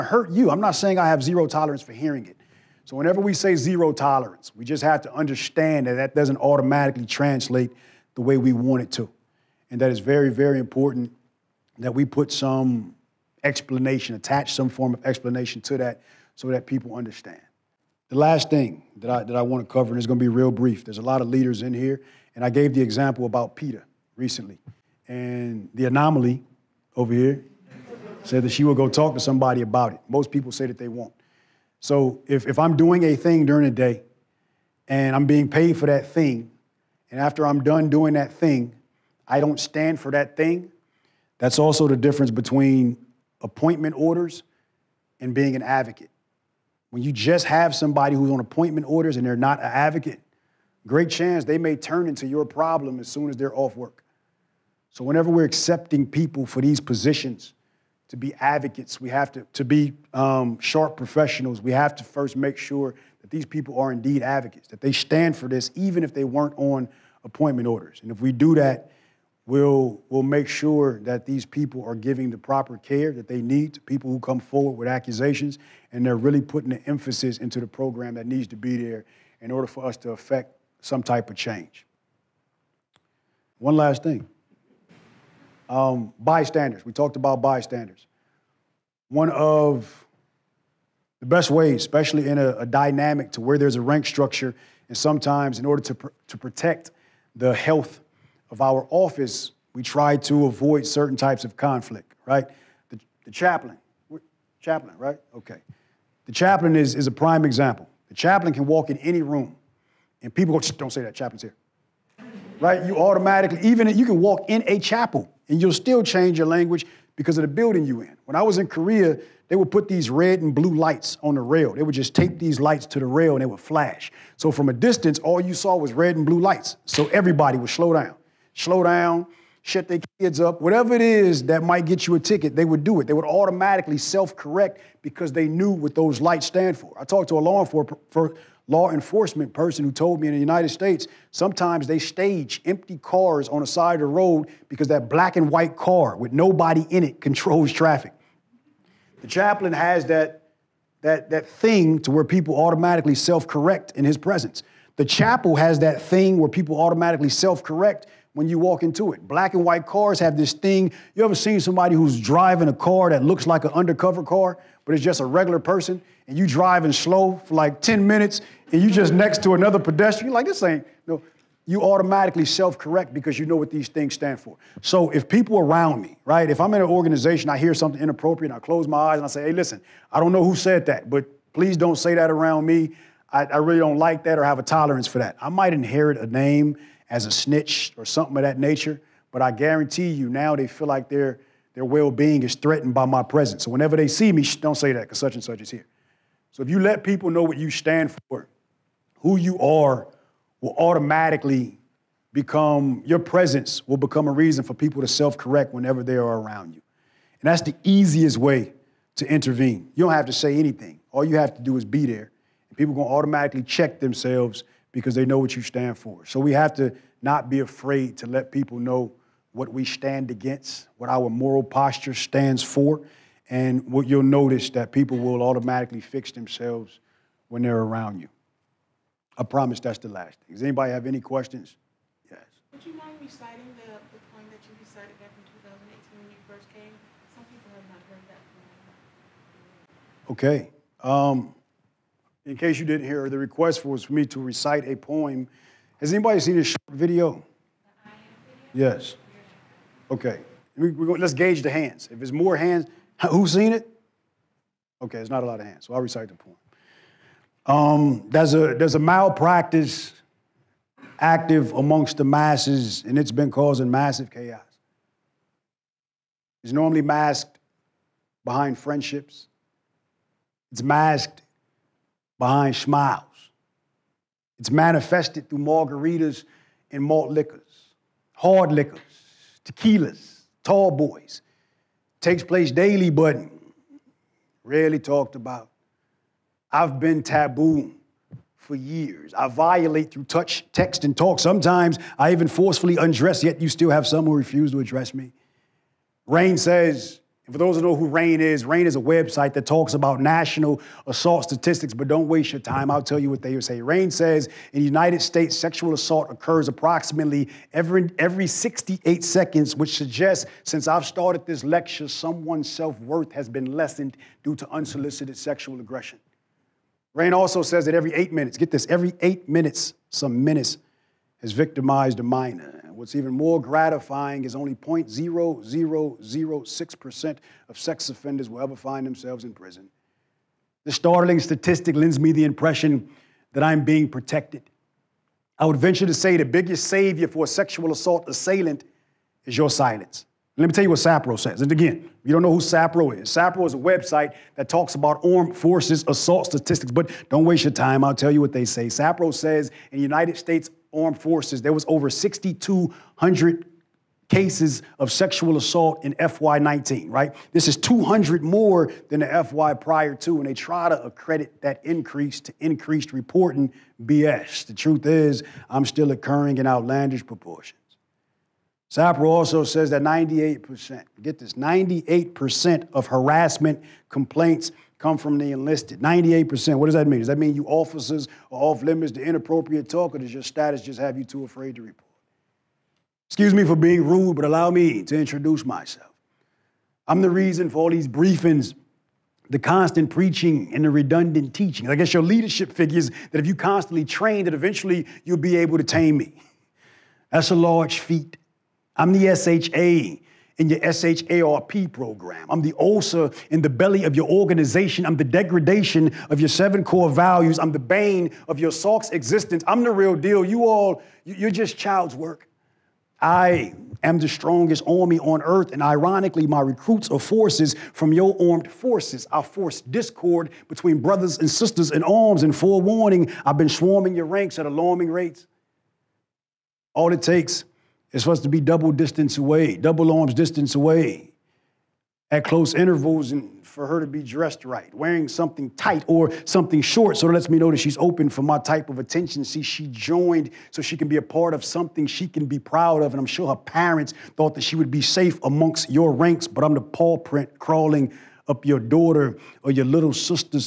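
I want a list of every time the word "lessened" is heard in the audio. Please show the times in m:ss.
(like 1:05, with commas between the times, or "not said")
5:13.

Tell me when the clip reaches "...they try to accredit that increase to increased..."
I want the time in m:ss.
6:00.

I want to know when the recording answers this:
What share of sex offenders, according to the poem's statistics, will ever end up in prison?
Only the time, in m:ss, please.
5:24.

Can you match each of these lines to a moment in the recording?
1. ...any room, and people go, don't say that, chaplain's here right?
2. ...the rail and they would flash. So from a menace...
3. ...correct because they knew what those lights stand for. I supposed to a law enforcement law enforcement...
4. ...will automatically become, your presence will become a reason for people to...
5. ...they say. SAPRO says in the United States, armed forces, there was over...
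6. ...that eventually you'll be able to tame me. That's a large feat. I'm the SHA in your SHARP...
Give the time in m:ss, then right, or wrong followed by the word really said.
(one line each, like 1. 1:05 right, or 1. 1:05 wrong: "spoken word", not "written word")
1. 1:48 right
2. 2:02 wrong: "distance", not "menace"
3. 2:14 wrong: "talked", not "supposed"
4. 3:20 right
5. 5:48 right
6. 6:34 right.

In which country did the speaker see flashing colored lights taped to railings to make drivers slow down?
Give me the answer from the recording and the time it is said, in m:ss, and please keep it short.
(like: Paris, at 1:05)
Korea, at 1:58.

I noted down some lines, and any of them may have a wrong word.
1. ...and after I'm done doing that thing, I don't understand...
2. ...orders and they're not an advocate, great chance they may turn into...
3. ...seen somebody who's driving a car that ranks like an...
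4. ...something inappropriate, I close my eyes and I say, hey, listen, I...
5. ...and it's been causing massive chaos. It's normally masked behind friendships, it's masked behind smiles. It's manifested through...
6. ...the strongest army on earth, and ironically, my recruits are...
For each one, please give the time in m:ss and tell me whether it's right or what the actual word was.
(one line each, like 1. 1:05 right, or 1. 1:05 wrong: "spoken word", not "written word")
1. 0:37 wrong: "stand", not "understand"
2. 0:48 right
3. 2:41 wrong: "looks", not "ranks"
4. 2:57 right
5. 4:23 right
6. 6:54 right.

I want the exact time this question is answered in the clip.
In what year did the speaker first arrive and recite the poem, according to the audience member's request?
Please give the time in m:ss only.
3:55.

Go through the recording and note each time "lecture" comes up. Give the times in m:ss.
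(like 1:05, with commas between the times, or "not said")
5:11.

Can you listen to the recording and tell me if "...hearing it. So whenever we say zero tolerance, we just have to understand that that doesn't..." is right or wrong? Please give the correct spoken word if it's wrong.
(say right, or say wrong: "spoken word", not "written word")
right.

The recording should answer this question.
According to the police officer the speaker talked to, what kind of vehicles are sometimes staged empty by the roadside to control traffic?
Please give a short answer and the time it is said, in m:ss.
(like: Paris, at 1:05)
black and white cars, at 2:25.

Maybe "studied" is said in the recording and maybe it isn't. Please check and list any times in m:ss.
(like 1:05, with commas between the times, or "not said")
not said.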